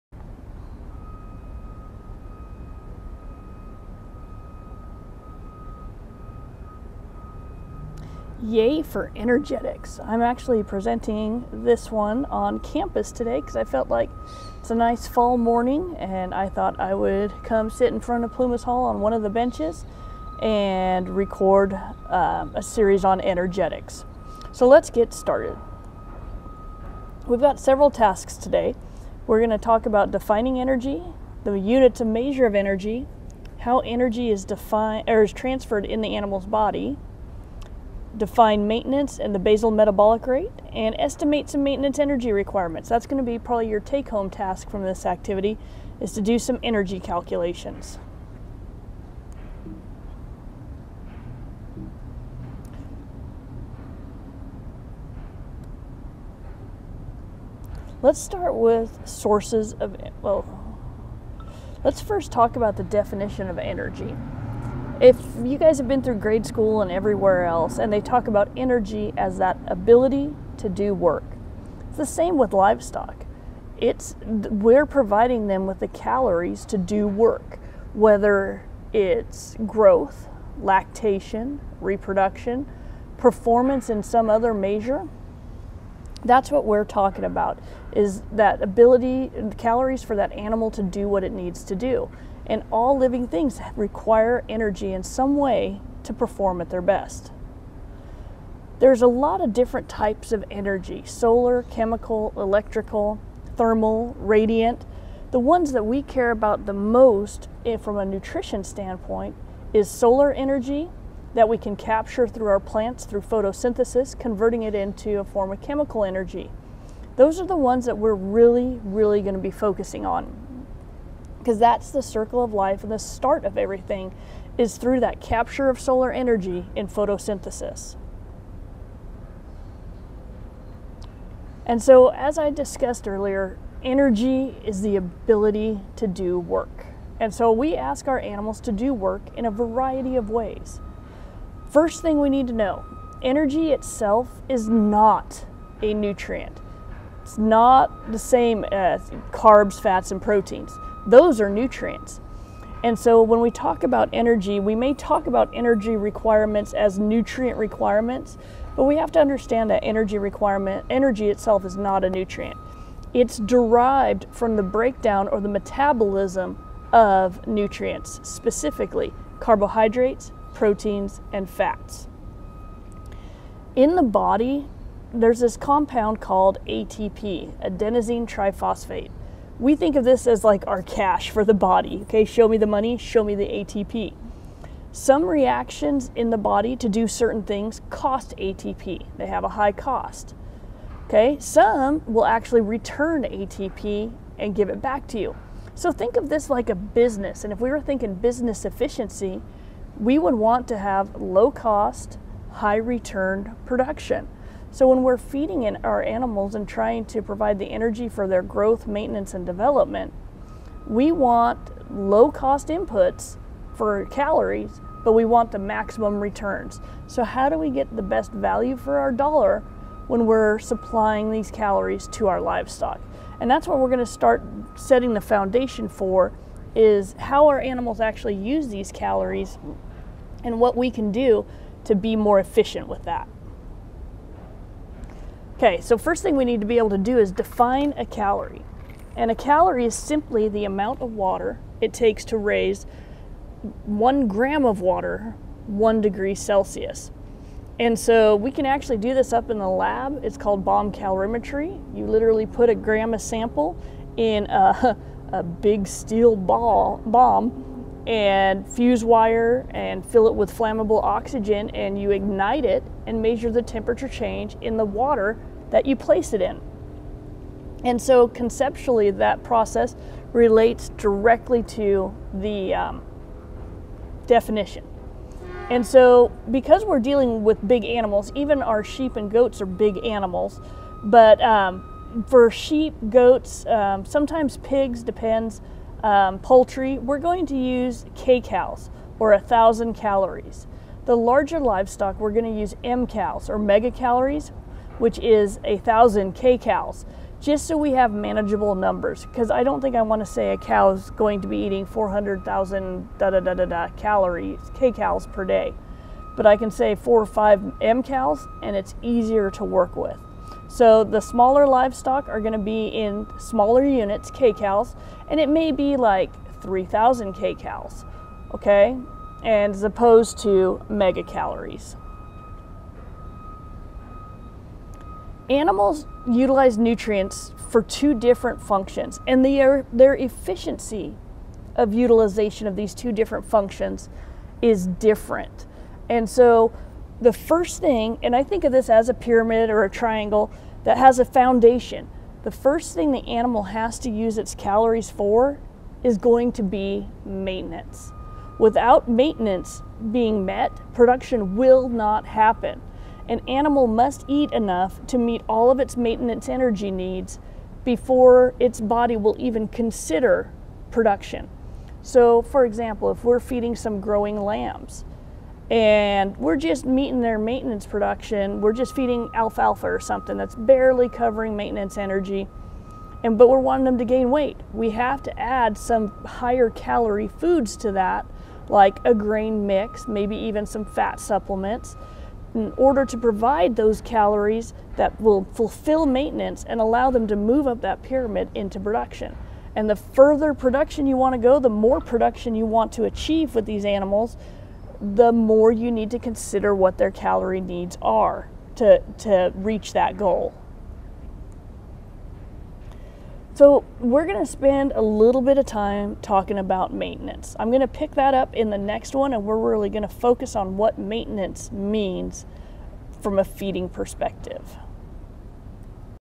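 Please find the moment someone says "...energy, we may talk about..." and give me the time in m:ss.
2:34.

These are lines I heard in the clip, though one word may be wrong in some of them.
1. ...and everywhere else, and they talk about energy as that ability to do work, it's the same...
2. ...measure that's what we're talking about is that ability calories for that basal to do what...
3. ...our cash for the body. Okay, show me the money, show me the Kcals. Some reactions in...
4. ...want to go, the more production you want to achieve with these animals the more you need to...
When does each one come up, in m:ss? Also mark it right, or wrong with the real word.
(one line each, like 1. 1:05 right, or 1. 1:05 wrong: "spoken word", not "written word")
1. 1:06 right
2. 1:24 wrong: "animal", not "basal"
3. 3:00 wrong: "ATP", not "Kcals"
4. 6:31 right.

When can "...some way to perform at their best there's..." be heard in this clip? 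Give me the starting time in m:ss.
1:35.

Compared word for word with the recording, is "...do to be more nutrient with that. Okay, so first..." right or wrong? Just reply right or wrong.
wrong.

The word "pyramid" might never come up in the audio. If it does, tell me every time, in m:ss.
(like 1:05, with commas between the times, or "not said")
5:39, 6:28.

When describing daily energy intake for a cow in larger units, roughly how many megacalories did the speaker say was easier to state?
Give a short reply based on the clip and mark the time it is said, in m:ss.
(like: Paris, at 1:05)
4 or 5, at 5:06.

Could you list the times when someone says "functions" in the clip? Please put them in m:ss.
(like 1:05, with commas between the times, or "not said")
5:28, 5:33.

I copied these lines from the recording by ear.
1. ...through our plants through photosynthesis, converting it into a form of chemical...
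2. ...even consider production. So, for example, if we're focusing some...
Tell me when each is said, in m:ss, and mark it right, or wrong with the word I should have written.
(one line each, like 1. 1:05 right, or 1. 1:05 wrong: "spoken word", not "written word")
1. 1:52 right
2. 5:59 wrong: "feeding", not "focusing".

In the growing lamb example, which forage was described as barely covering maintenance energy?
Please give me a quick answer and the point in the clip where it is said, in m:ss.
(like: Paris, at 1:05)
alfalfa, at 6:09.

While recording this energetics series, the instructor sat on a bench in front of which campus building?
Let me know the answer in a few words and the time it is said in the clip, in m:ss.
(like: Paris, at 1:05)
Plumas Hall, at 0:18.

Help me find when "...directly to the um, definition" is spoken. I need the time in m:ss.
4:30.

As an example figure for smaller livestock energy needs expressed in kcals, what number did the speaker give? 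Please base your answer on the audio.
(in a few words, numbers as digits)
3,000.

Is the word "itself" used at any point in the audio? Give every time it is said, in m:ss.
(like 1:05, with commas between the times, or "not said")
2:23, 2:41.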